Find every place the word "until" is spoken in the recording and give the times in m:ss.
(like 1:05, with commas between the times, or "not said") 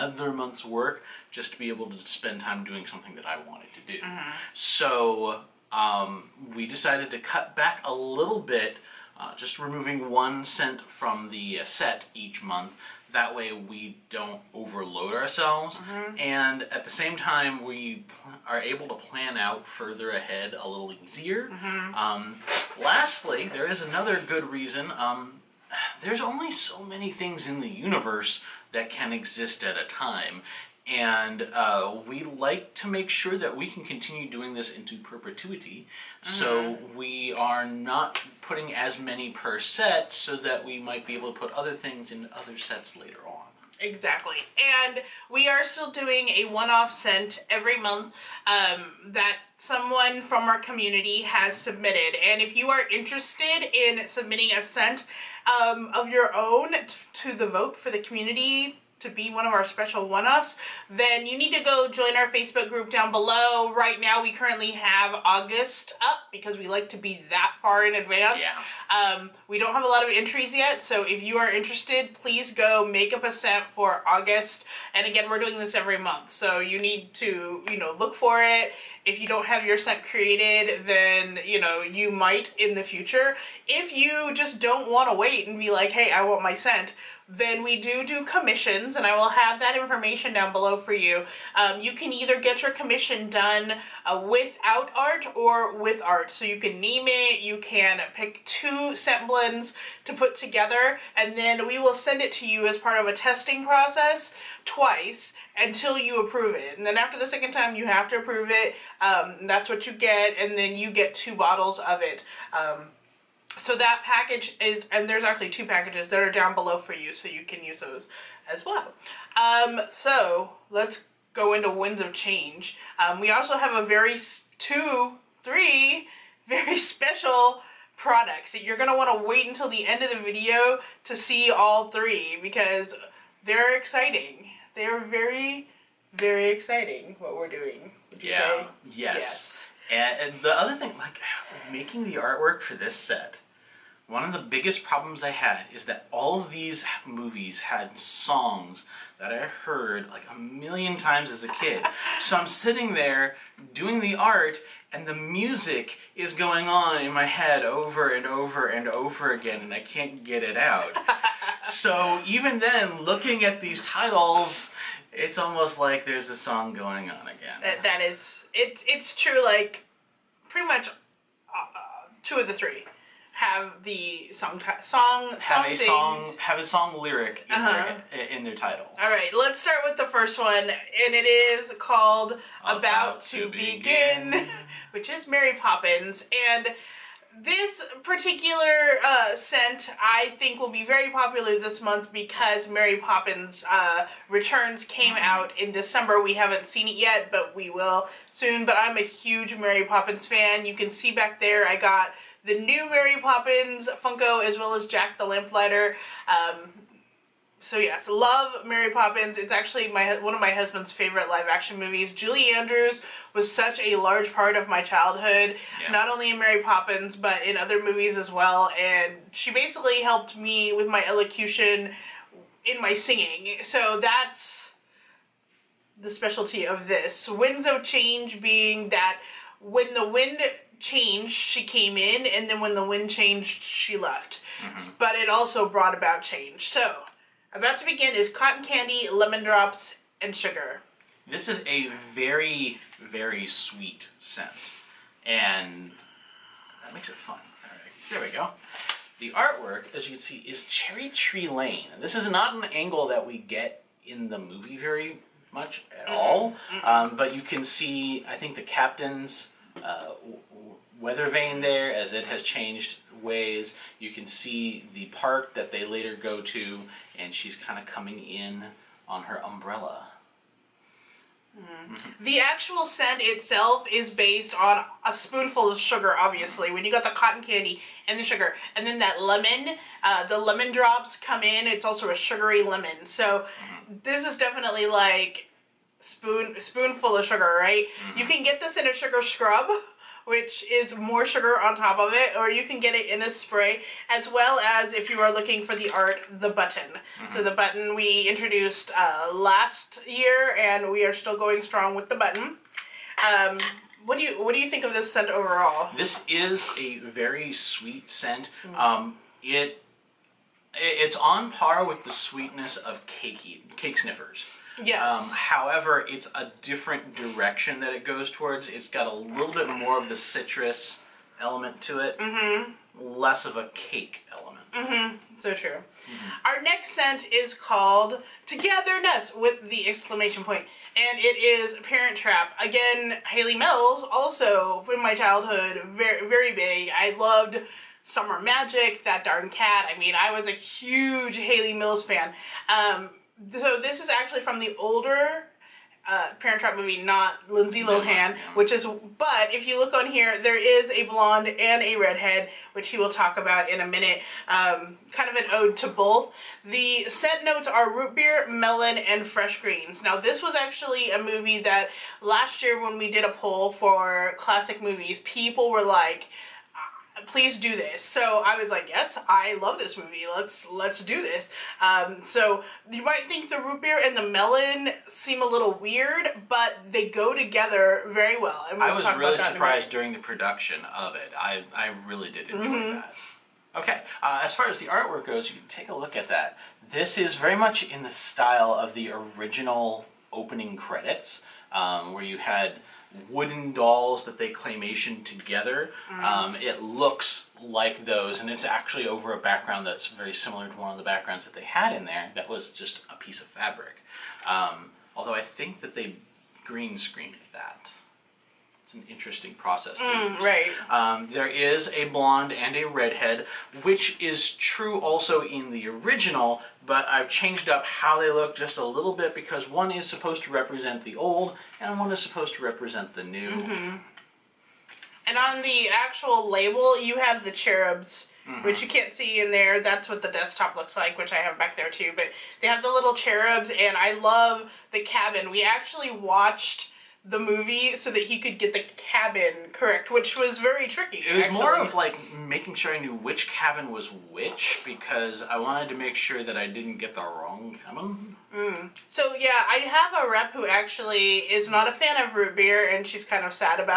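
1:45, 2:09.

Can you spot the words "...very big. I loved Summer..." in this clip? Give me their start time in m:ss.
5:36.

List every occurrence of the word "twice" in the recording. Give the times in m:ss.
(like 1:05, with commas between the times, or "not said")
1:44.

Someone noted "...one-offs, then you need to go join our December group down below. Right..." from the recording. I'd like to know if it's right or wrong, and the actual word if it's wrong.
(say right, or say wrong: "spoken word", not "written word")
wrong: "Facebook", not "December".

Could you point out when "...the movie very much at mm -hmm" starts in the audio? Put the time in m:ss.
4:14.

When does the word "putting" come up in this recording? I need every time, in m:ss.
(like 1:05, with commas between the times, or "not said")
0:38.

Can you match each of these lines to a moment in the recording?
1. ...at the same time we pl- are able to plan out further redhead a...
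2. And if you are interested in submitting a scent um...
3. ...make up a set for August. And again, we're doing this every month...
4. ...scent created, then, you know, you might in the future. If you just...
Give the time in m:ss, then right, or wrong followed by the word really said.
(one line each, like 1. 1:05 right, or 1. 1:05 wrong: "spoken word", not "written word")
1. 0:16 wrong: "ahead", not "redhead"
2. 0:52 right
3. 1:12 right
4. 1:19 right.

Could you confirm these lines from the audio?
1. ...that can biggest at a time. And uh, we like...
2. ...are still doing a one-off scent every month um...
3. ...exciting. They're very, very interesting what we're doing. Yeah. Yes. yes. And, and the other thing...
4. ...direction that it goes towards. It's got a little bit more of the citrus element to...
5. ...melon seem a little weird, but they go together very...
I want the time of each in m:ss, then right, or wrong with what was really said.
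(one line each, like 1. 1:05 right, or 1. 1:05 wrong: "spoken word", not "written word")
1. 0:28 wrong: "exist", not "biggest"
2. 0:45 right
3. 2:13 wrong: "exciting", not "interesting"
4. 5:17 right
5. 6:14 right.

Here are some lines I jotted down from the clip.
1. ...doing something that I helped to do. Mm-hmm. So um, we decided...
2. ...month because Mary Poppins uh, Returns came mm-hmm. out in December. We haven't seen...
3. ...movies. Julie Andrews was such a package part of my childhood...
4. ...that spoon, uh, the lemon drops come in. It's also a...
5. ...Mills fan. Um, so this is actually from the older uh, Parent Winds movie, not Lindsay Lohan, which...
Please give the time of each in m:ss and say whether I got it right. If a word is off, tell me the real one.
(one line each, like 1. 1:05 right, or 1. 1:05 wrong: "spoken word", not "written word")
1. 0:02 wrong: "wanted", not "helped"
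2. 3:11 right
3. 3:31 wrong: "large", not "package"
4. 4:38 wrong: "lemon", not "spoon"
5. 5:41 wrong: "Trap", not "Winds".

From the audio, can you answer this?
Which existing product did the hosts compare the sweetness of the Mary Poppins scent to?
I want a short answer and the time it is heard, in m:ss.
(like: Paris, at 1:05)
cakey cake sniffers, at 5:13.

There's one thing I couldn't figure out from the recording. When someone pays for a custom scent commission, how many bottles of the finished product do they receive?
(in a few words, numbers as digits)
2.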